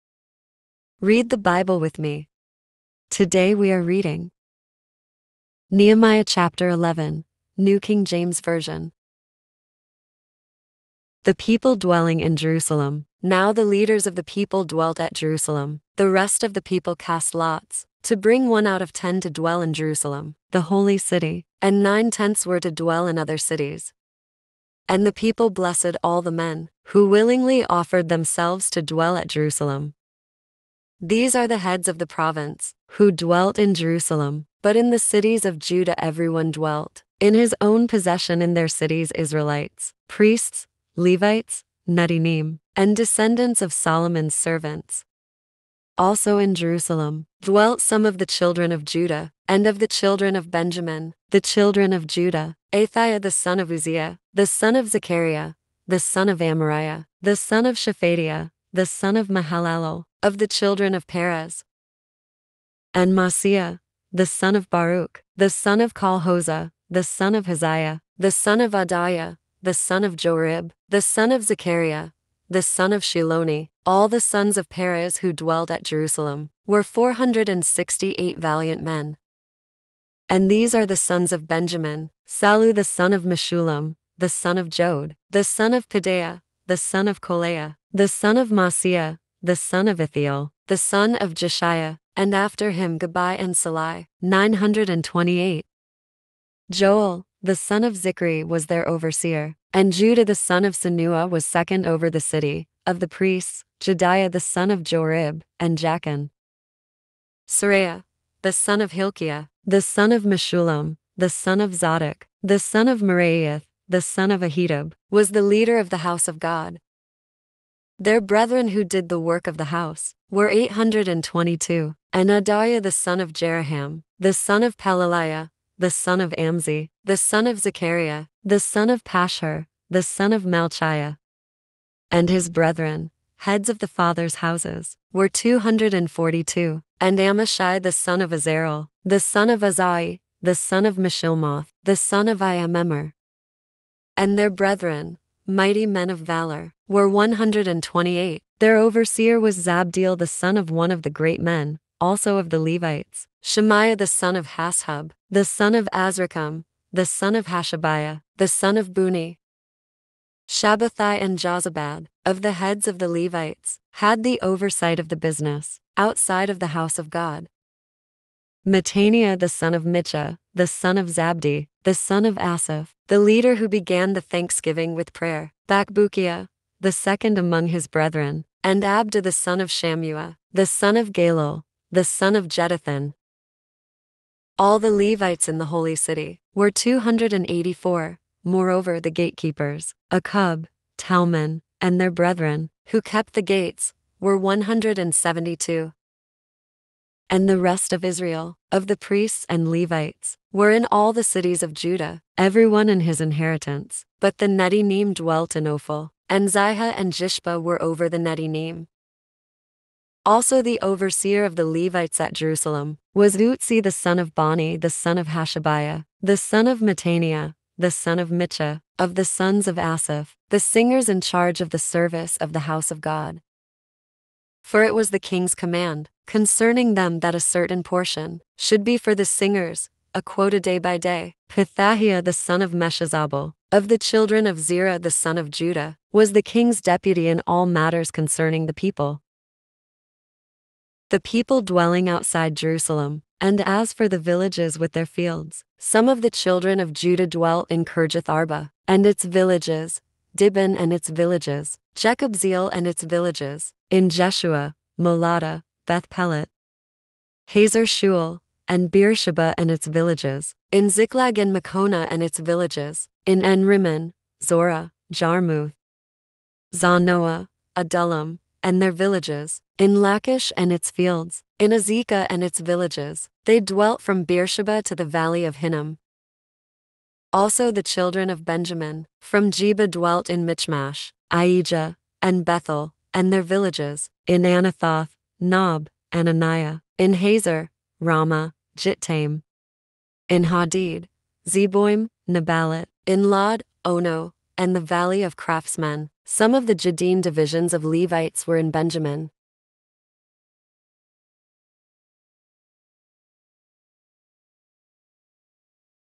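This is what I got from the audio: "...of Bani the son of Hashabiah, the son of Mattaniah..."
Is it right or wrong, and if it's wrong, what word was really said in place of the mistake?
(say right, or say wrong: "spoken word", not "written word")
right.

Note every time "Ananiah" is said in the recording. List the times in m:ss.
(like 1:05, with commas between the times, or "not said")
4:46.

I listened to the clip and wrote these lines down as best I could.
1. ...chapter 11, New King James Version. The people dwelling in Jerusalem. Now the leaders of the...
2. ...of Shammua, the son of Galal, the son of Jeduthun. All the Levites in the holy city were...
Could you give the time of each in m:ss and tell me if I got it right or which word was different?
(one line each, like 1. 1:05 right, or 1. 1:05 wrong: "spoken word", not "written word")
1. 0:06 right
2. 2:59 right.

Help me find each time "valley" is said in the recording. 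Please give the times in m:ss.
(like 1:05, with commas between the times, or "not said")
4:35, 4:54.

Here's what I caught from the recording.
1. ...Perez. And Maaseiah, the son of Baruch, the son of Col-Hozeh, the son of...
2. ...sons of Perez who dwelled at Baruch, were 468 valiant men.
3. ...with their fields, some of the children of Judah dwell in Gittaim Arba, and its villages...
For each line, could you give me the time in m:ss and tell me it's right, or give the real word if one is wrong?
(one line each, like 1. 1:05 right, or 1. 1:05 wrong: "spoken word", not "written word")
1. 1:01 right
2. 1:14 wrong: "Jerusalem", not "Baruch"
3. 4:04 wrong: "Kirjath", not "Gittaim".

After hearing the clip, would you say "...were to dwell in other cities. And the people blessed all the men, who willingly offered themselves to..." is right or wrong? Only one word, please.
right.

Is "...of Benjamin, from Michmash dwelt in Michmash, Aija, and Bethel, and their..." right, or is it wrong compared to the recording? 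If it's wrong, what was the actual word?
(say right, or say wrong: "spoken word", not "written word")
wrong: "Geba", not "Michmash".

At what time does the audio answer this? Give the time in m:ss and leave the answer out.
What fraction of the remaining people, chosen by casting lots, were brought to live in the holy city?
0:18.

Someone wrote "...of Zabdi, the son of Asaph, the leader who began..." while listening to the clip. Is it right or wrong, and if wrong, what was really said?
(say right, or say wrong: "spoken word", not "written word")
right.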